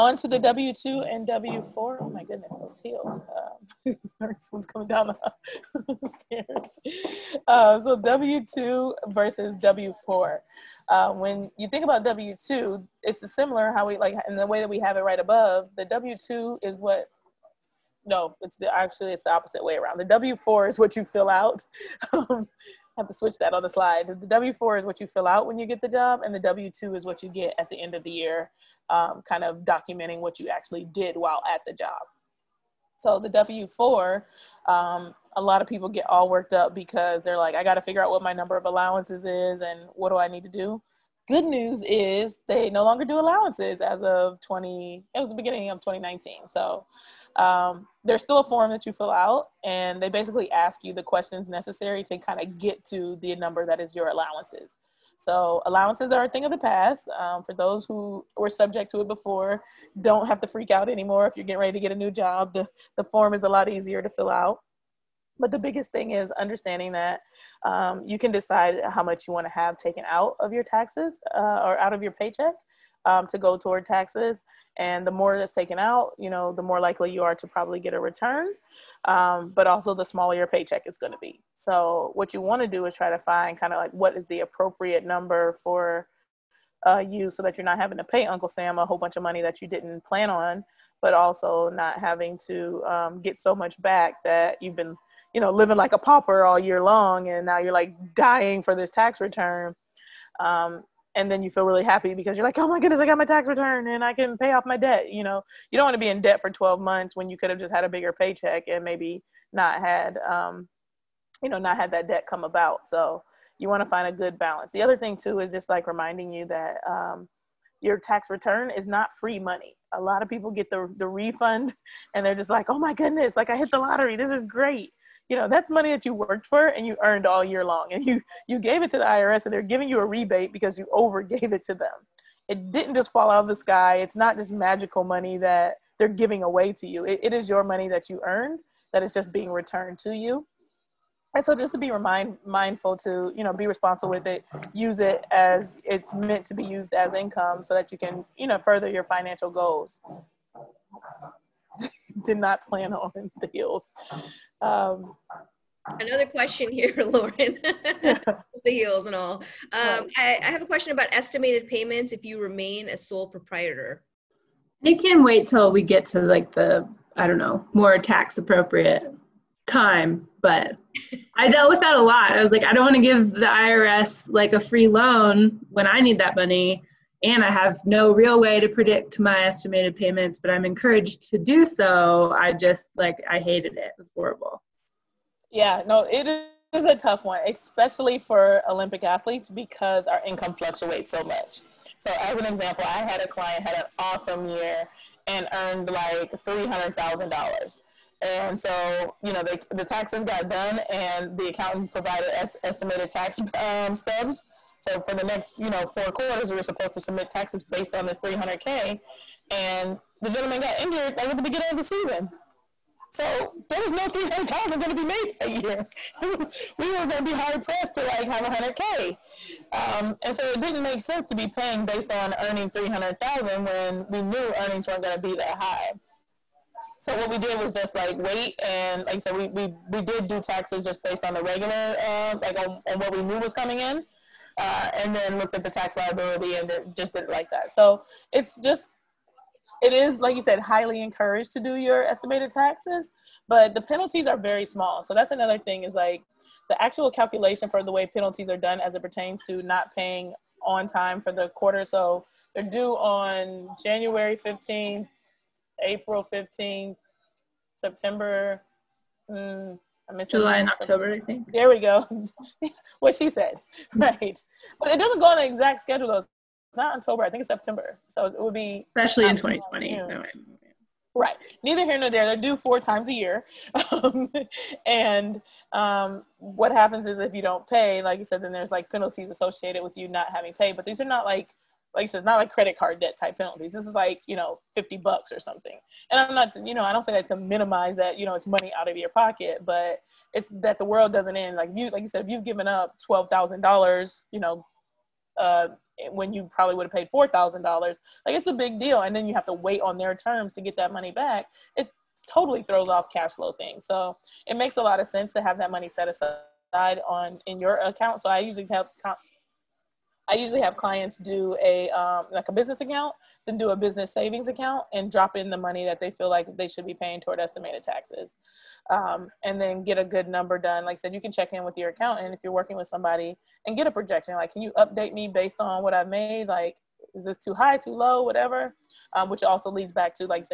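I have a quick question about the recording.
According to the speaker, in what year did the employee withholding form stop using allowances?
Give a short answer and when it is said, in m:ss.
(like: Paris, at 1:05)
2019, at 0:45.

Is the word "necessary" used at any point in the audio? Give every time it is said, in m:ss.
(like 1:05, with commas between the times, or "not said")
0:51.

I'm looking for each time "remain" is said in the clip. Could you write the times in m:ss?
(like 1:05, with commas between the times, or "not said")
2:42.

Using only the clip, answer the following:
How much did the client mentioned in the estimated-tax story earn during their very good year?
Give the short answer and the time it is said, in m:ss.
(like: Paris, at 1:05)
$300,000, at 3:16.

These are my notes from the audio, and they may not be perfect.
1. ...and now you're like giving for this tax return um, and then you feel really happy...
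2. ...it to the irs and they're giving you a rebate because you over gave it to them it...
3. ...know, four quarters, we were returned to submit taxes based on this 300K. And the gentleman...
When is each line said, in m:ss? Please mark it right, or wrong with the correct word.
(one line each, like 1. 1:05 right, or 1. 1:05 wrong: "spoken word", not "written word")
1. 1:37 wrong: "dying", not "giving"
2. 2:08 right
3. 3:25 wrong: "supposed", not "returned".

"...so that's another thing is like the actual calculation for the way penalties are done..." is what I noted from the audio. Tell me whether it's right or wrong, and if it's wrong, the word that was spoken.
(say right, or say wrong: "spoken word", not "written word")
right.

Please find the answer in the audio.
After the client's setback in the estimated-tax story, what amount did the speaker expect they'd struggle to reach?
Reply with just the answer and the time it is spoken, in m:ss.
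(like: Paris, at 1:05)
100K, at 3:38.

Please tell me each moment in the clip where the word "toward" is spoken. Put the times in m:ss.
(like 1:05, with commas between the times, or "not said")
1:13, 5:17.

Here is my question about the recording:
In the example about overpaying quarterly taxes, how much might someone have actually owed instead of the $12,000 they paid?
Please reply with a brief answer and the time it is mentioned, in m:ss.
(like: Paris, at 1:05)
$4,000, at 4:57.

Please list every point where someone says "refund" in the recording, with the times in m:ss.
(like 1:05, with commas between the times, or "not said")
2:01.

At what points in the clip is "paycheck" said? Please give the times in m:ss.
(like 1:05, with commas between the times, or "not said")
1:12, 1:20, 1:48.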